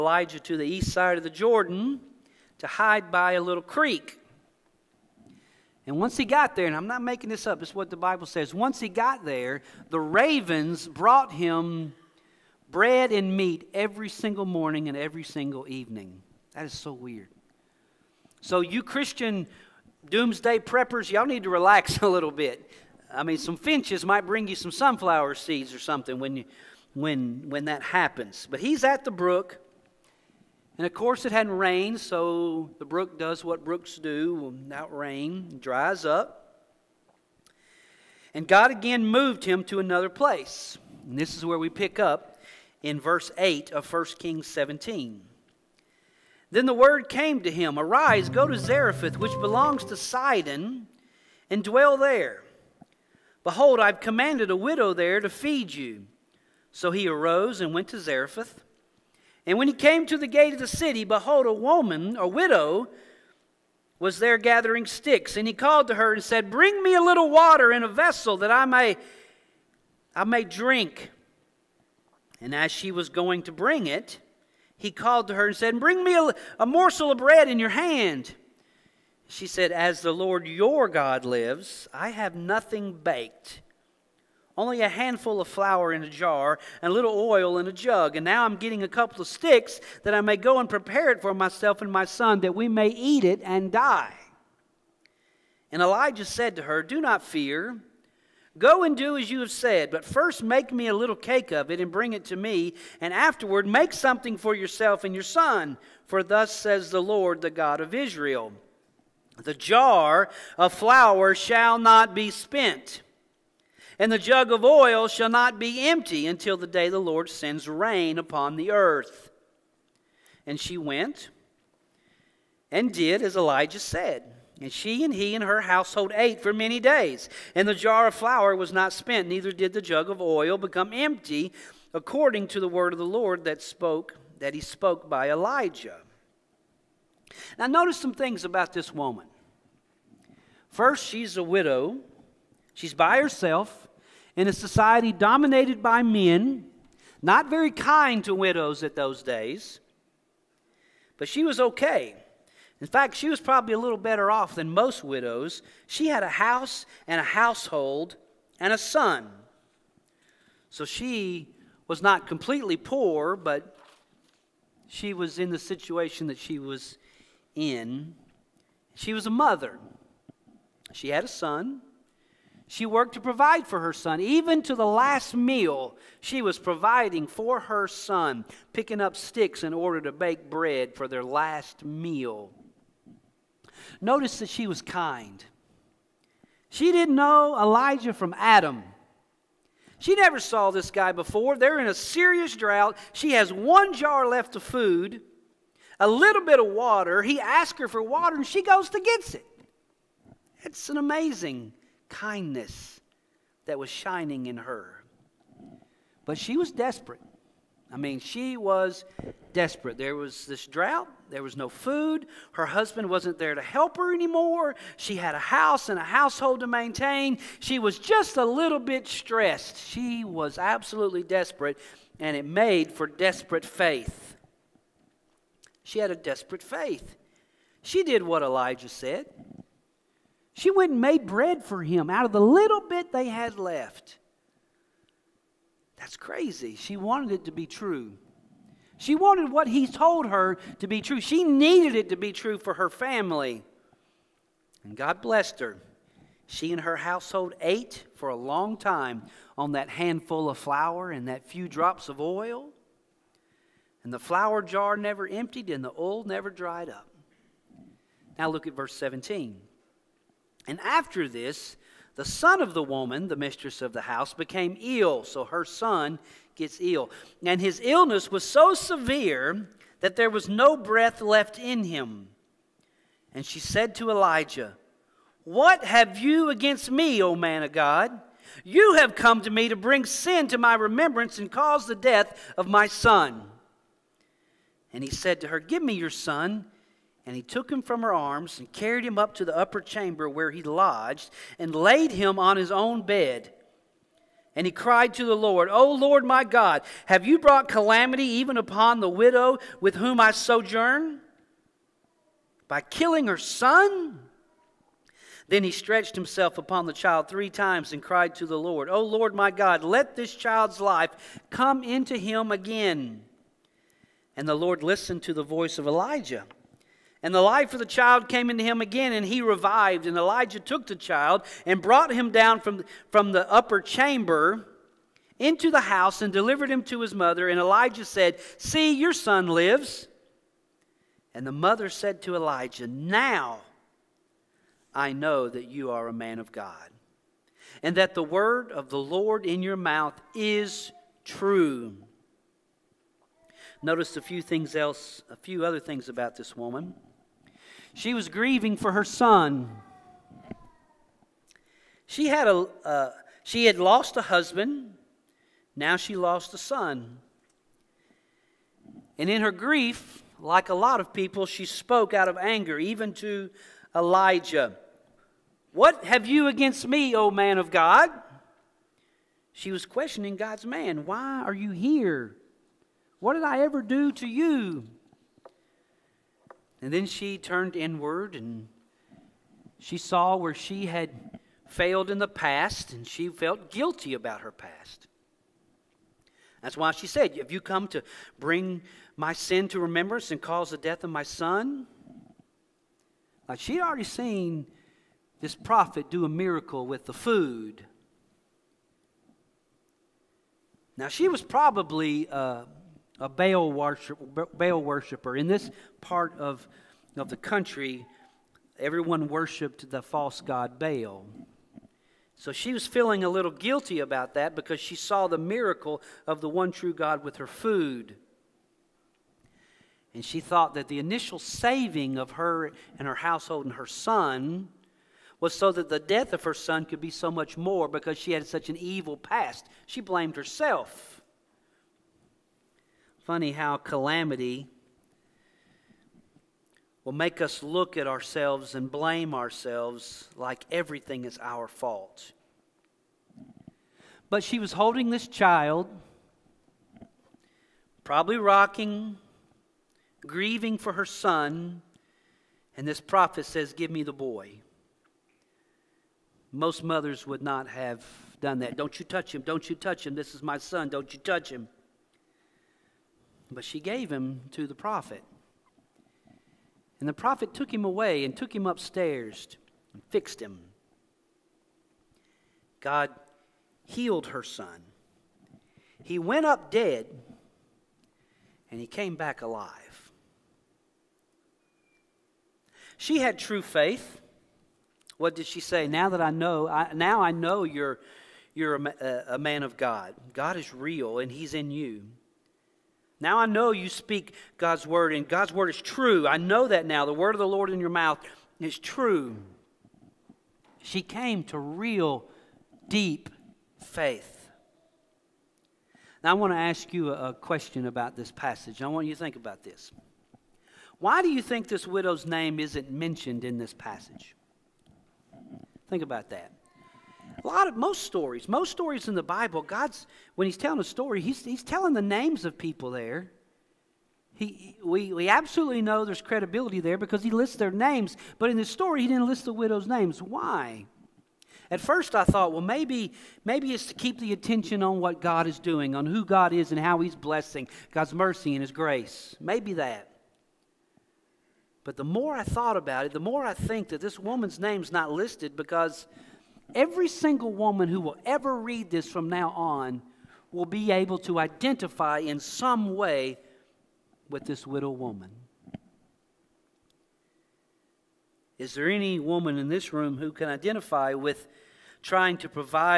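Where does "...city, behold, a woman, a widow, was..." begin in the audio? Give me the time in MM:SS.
01:00.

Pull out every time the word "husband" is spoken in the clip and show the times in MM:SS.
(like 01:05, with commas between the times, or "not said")
03:32, 05:54.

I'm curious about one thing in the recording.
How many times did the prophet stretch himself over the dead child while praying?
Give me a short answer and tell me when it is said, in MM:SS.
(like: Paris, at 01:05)
3, at 05:07.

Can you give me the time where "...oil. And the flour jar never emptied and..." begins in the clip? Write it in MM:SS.
04:12.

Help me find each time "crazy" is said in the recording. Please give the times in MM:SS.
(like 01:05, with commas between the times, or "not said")
03:56.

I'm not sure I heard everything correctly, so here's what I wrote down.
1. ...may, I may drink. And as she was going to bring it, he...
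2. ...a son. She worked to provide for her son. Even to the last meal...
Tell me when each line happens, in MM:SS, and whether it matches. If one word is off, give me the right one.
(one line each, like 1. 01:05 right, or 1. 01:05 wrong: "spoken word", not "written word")
1. 01:08 right
2. 02:51 right.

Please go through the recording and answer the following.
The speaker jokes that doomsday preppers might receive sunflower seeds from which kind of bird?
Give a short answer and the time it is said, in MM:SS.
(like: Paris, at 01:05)
Finches, at 00:23.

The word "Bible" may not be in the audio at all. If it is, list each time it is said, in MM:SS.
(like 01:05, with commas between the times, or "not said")
00:07, 08:39.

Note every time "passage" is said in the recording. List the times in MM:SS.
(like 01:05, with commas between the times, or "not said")
08:28, 08:33.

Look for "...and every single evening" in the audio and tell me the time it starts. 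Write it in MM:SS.
00:14.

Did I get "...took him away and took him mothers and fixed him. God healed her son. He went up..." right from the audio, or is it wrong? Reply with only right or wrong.
wrong.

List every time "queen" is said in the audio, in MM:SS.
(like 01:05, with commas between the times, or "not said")
not said.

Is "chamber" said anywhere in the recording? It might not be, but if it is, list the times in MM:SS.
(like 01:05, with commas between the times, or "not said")
04:49, 05:23.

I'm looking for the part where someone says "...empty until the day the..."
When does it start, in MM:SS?
01:55.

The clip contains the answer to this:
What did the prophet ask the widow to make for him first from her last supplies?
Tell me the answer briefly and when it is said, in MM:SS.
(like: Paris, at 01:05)
A little cake, at 01:40.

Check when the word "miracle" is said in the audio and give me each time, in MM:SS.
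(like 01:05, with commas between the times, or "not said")
06:36, 06:55.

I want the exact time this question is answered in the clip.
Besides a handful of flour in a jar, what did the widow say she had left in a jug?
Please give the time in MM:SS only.
01:26.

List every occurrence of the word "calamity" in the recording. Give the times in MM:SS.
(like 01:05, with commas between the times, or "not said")
04:57, 07:13.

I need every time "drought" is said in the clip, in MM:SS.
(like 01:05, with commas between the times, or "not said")
03:12, 03:30.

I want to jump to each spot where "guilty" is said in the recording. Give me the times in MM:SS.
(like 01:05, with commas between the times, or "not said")
06:23, 06:53.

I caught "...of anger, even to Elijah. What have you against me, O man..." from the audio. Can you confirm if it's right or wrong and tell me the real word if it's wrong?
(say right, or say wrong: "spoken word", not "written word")
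right.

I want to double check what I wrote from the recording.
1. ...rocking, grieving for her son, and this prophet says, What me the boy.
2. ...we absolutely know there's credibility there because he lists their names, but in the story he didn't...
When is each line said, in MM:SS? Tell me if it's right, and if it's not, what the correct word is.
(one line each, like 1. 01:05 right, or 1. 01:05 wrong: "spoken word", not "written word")
1. 07:28 wrong: "Give", not "What"
2. 08:45 right.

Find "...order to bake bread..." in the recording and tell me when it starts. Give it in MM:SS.
02:59.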